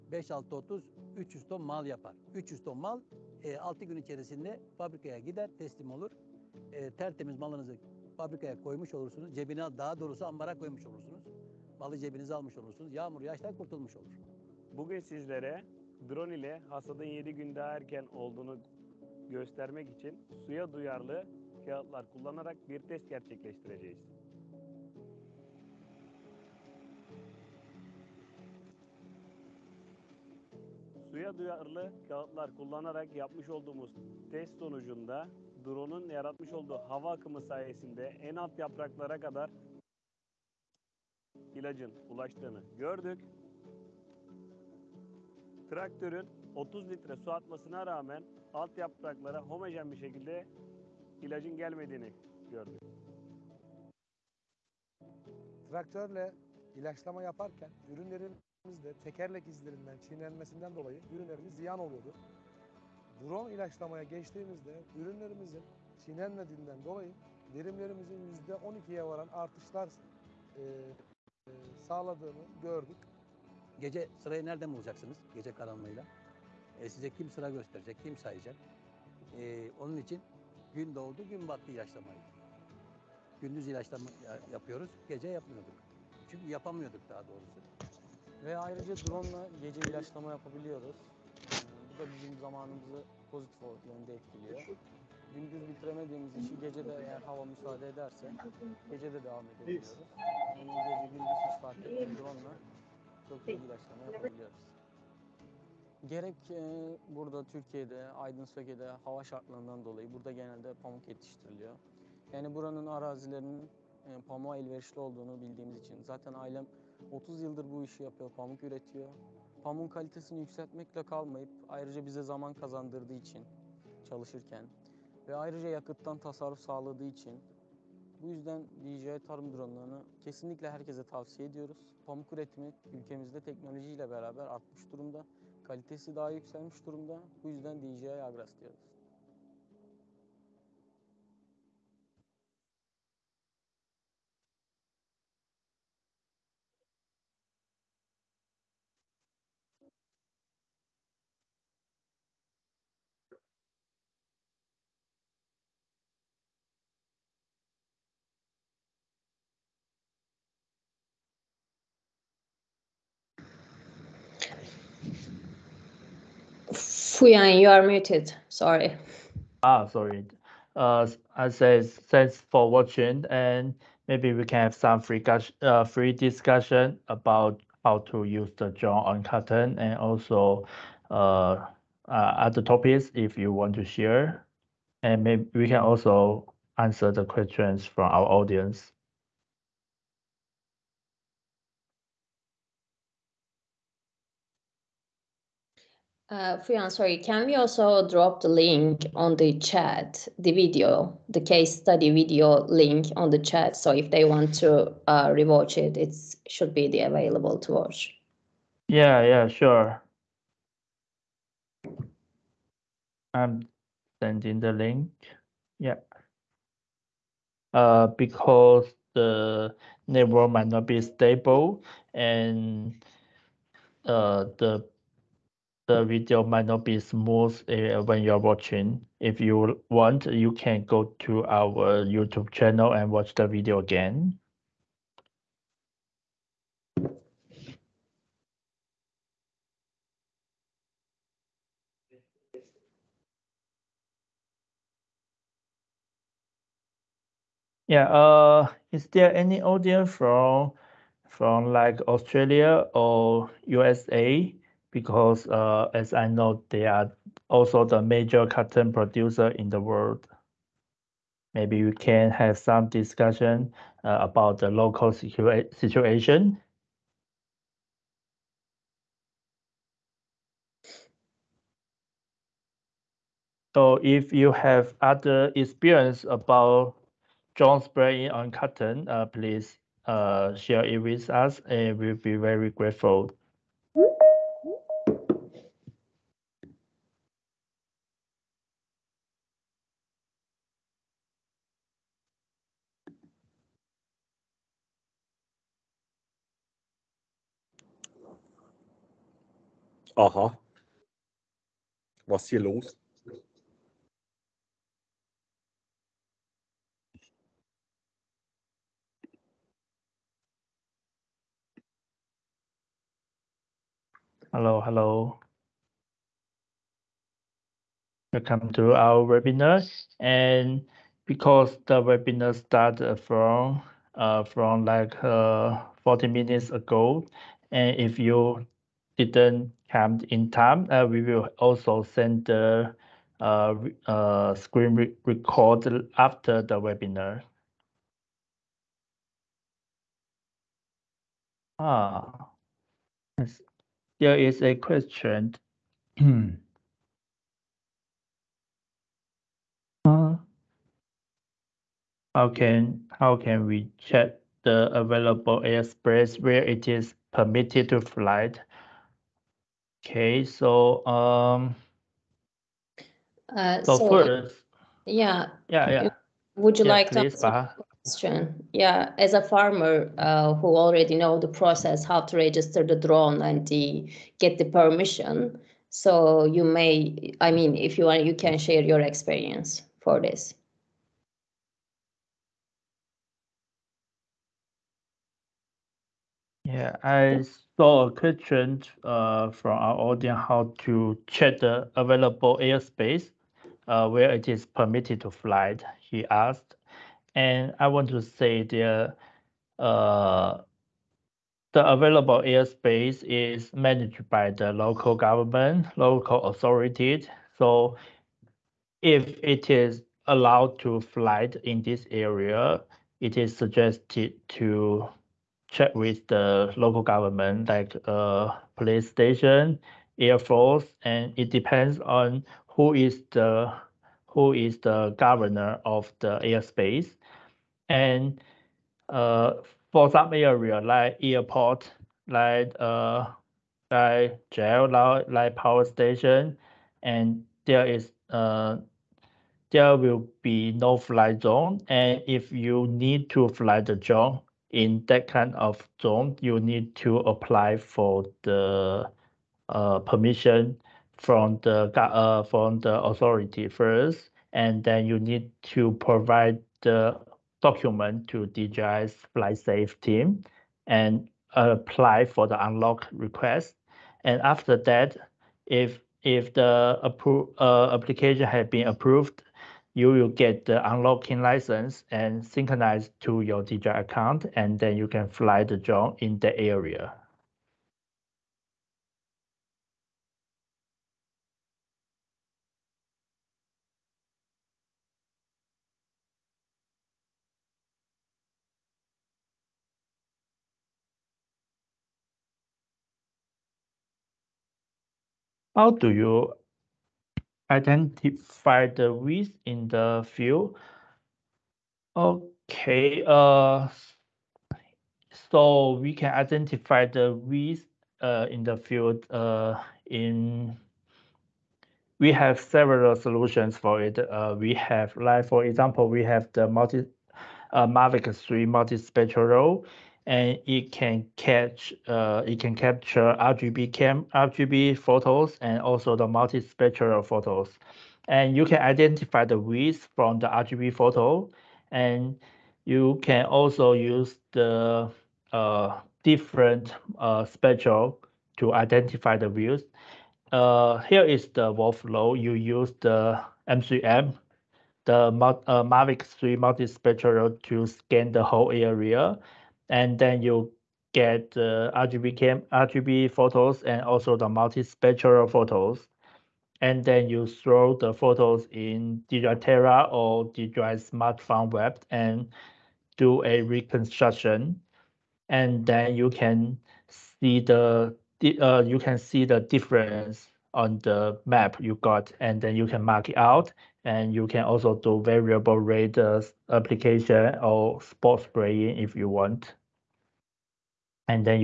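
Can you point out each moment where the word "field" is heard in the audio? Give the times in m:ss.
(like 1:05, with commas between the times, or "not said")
8:20, 8:28.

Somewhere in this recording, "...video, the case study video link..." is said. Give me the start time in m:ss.
3:20.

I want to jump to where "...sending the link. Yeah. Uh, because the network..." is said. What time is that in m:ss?
3:34.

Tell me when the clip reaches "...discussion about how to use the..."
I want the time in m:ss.
2:56.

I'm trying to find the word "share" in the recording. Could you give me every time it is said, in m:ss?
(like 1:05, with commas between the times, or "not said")
3:03, 4:40, 6:18.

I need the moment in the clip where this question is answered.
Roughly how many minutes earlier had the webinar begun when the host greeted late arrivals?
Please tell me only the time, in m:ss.
5:26.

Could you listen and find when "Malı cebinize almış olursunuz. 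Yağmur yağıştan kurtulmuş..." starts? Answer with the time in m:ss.
0:11.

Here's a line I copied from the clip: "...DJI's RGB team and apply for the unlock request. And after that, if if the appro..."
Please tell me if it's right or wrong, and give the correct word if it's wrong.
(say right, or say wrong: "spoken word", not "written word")
wrong: "FlySafe", not "RGB".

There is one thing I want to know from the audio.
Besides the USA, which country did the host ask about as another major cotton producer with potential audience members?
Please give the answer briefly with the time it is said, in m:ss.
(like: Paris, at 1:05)
Australia, at 4:12.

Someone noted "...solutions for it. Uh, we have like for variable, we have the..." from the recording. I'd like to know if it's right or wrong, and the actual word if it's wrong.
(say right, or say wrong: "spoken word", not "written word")
wrong: "example", not "variable".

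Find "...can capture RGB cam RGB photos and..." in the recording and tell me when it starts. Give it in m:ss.
8:42.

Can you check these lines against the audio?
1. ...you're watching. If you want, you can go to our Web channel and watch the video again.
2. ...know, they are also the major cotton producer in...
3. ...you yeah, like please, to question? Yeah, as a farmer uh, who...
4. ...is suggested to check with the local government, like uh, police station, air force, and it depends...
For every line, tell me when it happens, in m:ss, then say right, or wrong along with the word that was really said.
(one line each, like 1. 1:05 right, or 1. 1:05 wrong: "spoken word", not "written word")
1. 3:48 wrong: "YouTube", not "Web"
2. 4:16 right
3. 6:06 right
4. 6:53 right.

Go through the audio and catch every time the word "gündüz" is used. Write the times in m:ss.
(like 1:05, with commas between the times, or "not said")
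1:23, 1:35, 1:41.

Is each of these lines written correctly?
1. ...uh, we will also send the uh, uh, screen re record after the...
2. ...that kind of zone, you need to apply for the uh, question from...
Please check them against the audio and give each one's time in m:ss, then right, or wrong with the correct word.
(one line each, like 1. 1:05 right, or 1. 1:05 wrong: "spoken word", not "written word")
1. 5:30 right
2. 7:25 wrong: "permission", not "question".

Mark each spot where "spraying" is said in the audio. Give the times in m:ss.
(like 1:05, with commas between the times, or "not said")
4:37, 9:38.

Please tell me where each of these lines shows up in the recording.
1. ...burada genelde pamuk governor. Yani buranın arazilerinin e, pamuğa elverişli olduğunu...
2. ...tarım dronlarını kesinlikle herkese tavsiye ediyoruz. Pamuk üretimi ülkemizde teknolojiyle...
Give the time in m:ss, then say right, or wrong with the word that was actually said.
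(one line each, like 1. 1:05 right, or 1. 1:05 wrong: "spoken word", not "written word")
1. 1:50 wrong: "yetiştiriliyor", not "governor"
2. 2:09 right.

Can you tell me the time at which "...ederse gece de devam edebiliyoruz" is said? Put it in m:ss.
1:37.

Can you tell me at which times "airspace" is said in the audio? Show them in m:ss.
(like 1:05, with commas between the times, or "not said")
5:55, 6:32, 6:42, 7:06.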